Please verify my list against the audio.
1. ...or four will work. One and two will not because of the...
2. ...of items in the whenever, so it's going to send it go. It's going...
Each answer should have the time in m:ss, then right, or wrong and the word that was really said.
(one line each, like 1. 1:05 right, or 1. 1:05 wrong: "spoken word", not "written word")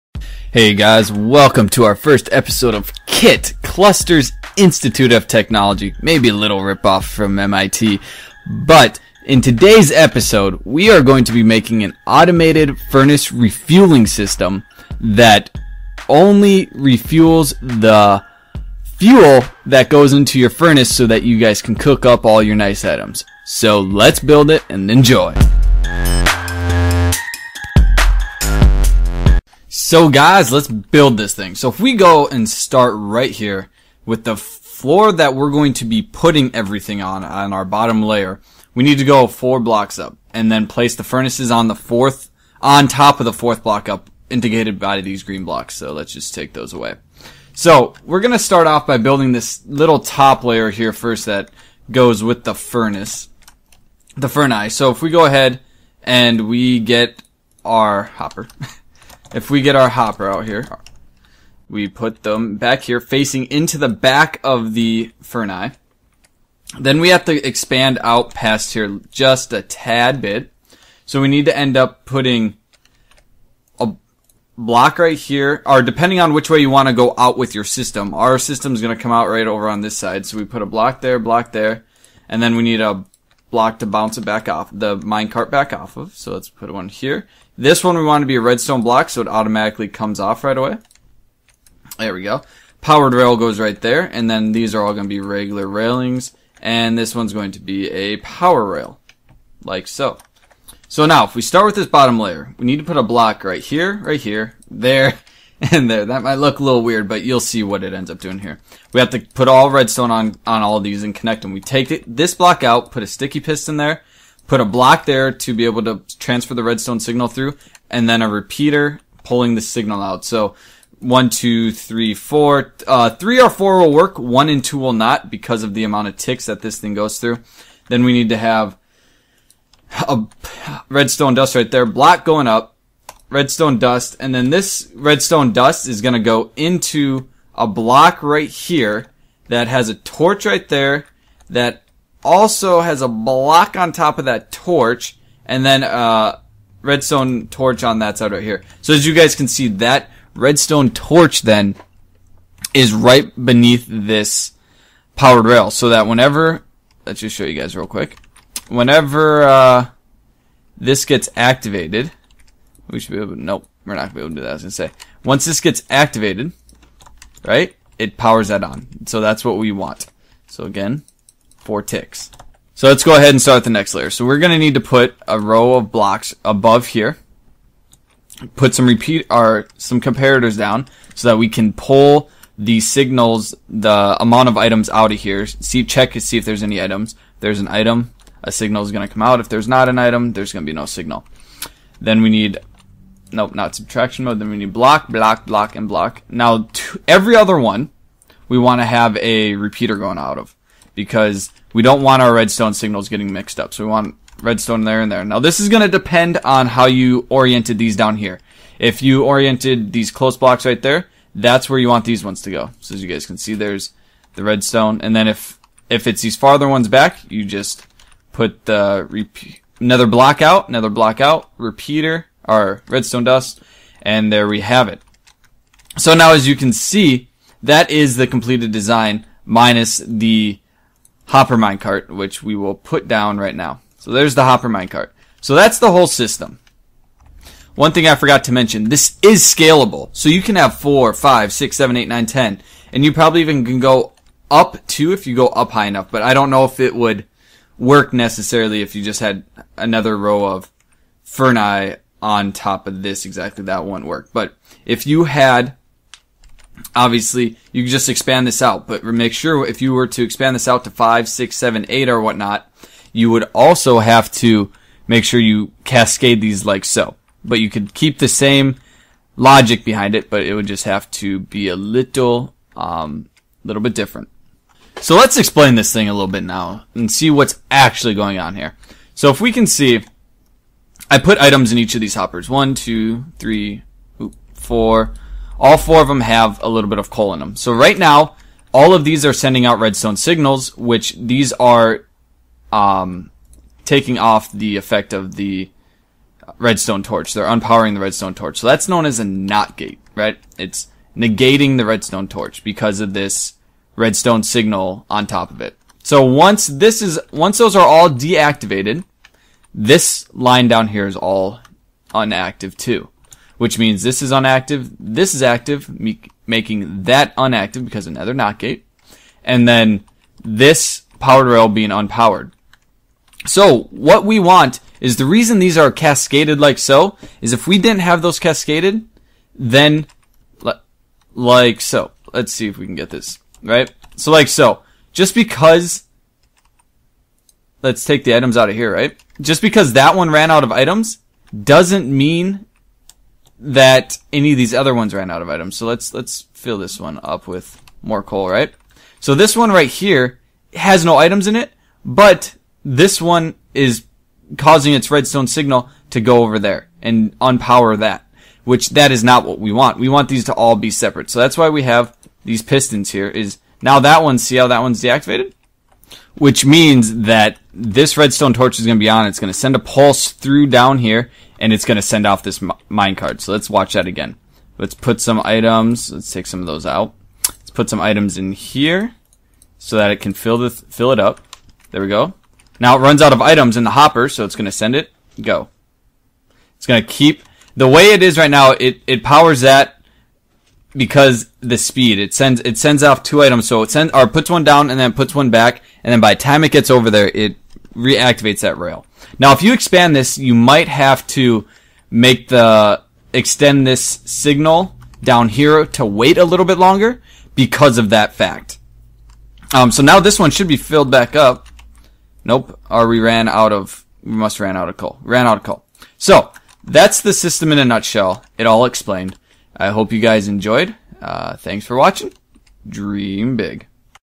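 1. 2:03 right
2. 6:23 wrong: "hopper", not "whenever".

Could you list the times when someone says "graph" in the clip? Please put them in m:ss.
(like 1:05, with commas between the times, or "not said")
not said.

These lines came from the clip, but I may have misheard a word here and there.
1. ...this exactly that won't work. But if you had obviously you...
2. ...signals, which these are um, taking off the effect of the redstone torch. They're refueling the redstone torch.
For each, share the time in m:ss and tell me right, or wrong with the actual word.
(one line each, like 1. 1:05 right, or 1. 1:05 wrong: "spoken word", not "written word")
1. 4:13 right
2. 4:50 wrong: "unpowering", not "refueling".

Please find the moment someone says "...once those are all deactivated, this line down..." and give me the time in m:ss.
5:07.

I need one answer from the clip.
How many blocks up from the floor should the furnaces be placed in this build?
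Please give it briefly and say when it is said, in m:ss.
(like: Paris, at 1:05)
4, at 0:39.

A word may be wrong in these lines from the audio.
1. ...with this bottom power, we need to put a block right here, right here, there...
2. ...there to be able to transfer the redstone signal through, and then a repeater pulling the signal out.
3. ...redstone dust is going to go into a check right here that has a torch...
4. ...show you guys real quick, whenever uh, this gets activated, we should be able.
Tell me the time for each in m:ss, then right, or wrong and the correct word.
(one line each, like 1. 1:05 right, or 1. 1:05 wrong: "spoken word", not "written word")
1. 1:41 wrong: "layer", not "power"
2. 1:55 right
3. 2:14 wrong: "block", not "check"
4. 2:37 right.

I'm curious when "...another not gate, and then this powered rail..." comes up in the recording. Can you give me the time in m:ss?
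5:18.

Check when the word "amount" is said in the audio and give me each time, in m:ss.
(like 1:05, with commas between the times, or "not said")
2:05, 3:04.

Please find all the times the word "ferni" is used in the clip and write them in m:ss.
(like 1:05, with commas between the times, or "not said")
1:05, 4:11.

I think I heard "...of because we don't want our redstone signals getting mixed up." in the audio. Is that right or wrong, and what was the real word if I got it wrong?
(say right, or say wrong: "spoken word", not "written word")
right.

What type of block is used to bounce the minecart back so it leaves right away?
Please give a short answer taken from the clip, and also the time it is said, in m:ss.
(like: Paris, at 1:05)
Redstone block, at 1:28.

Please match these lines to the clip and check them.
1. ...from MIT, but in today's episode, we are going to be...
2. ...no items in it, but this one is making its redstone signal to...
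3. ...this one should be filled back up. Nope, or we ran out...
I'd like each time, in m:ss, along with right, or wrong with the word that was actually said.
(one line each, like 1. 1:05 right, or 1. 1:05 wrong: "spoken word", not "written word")
1. 0:07 right
2. 5:51 wrong: "causing", not "making"
3. 6:50 right.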